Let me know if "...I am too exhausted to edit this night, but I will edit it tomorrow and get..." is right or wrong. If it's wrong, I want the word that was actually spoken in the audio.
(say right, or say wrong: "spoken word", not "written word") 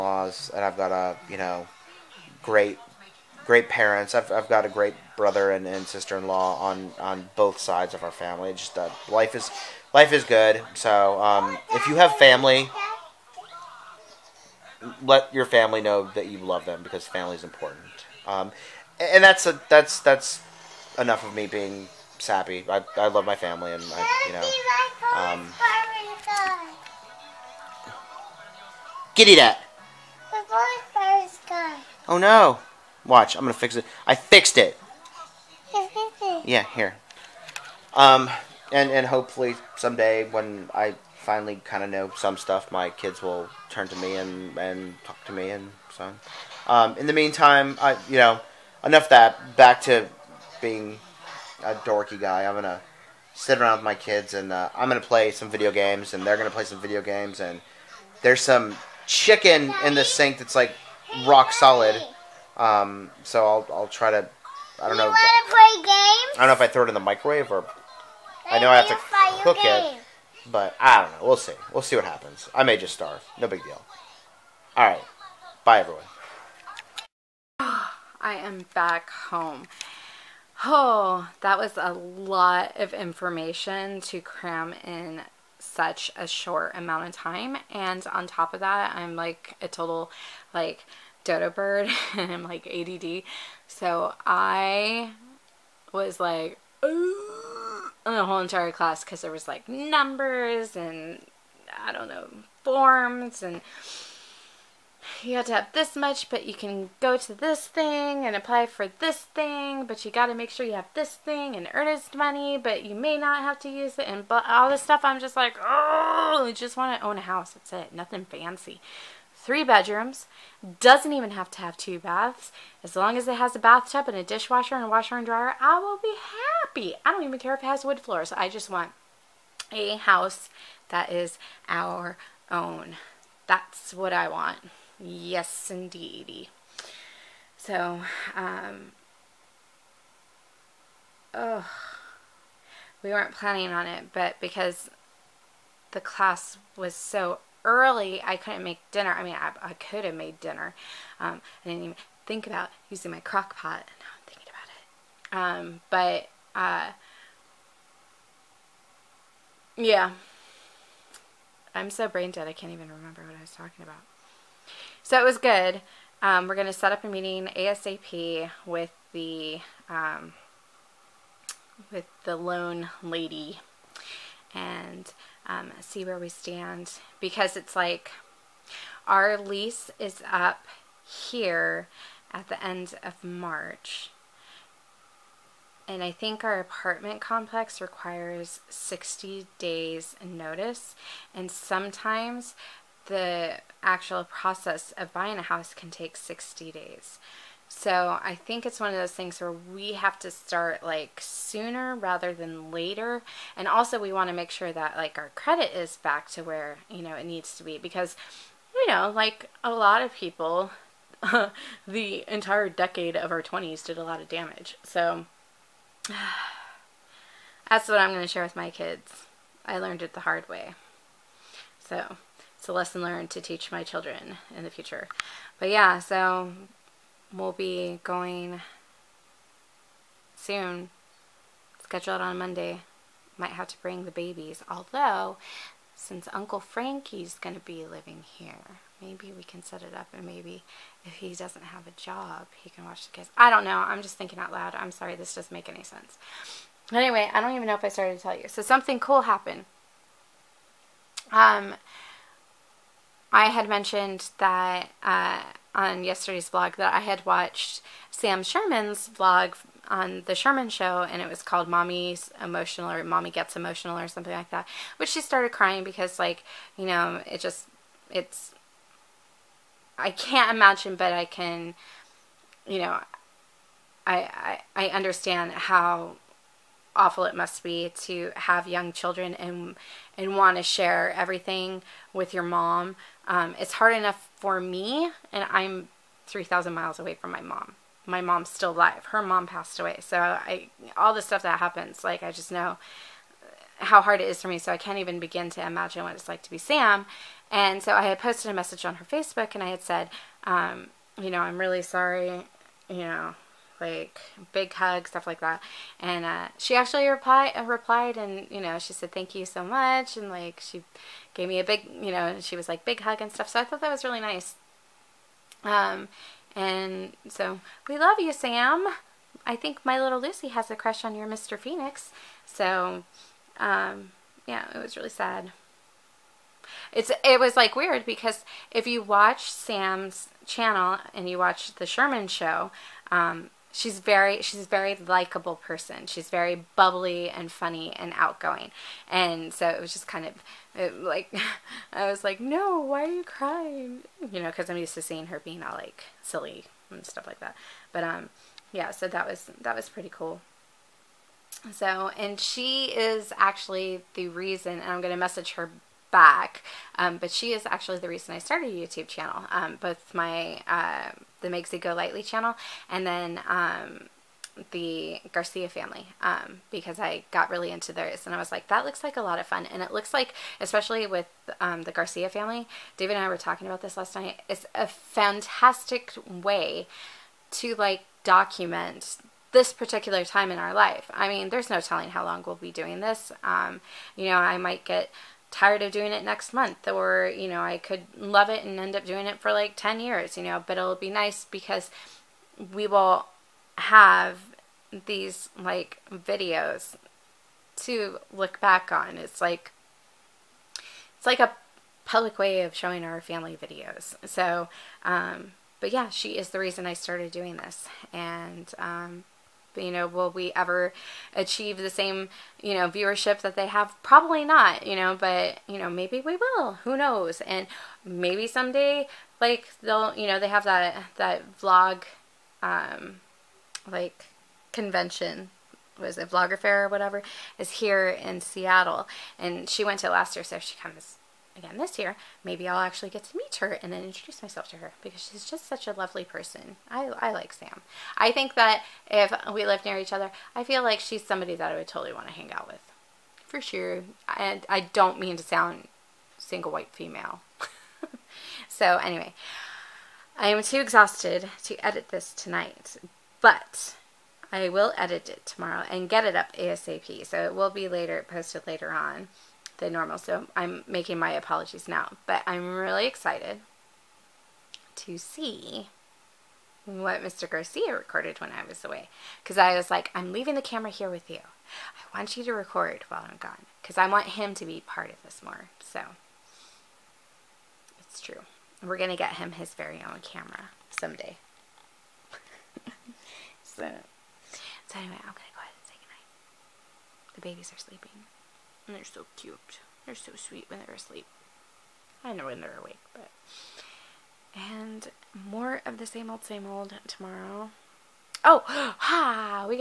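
wrong: "tonight", not "night".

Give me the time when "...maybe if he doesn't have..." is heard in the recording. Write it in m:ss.
4:00.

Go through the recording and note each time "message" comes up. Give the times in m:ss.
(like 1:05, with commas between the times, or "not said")
4:58, 5:55.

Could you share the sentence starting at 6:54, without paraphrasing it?
Probably not, you know, but, you know, maybe we will.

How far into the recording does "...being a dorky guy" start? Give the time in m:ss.
0:50.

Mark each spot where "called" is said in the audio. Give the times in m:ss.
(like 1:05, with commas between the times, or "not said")
4:21.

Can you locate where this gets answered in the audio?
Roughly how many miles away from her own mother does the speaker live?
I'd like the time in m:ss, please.
4:46.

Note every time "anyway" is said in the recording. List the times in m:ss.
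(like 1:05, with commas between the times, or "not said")
4:06, 7:28, 8:03.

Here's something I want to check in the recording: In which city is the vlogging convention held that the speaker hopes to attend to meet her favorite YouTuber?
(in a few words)
Seattle.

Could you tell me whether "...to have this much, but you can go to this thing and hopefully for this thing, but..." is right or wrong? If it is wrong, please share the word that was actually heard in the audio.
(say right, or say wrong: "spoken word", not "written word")
wrong: "apply", not "hopefully".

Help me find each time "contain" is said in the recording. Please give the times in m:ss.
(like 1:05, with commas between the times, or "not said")
not said.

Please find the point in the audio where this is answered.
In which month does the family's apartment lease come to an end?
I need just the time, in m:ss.
3:03.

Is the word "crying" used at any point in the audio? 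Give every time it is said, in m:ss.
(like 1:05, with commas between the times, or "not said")
4:25, 5:43.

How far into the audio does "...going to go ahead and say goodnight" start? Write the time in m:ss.
8:05.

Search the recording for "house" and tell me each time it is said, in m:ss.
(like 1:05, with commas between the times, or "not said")
1:57, 2:09, 3:15.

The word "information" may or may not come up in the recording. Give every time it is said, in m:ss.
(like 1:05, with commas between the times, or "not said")
1:22.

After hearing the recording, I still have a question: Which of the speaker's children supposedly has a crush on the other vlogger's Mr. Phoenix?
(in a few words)
Lucy.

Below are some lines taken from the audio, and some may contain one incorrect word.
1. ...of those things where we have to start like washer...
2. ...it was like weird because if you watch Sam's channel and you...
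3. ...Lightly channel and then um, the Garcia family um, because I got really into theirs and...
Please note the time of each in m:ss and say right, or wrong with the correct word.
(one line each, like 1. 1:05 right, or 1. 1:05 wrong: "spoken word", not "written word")
1. 3:18 wrong: "sooner", not "washer"
2. 5:27 right
3. 6:01 right.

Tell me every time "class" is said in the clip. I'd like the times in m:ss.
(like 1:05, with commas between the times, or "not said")
1:38, 2:25.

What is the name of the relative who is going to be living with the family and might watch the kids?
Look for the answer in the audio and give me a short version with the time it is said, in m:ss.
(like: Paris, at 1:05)
Uncle Frankie, at 3:56.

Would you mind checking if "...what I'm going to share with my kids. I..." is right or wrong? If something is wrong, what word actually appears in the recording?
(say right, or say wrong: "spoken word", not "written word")
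right.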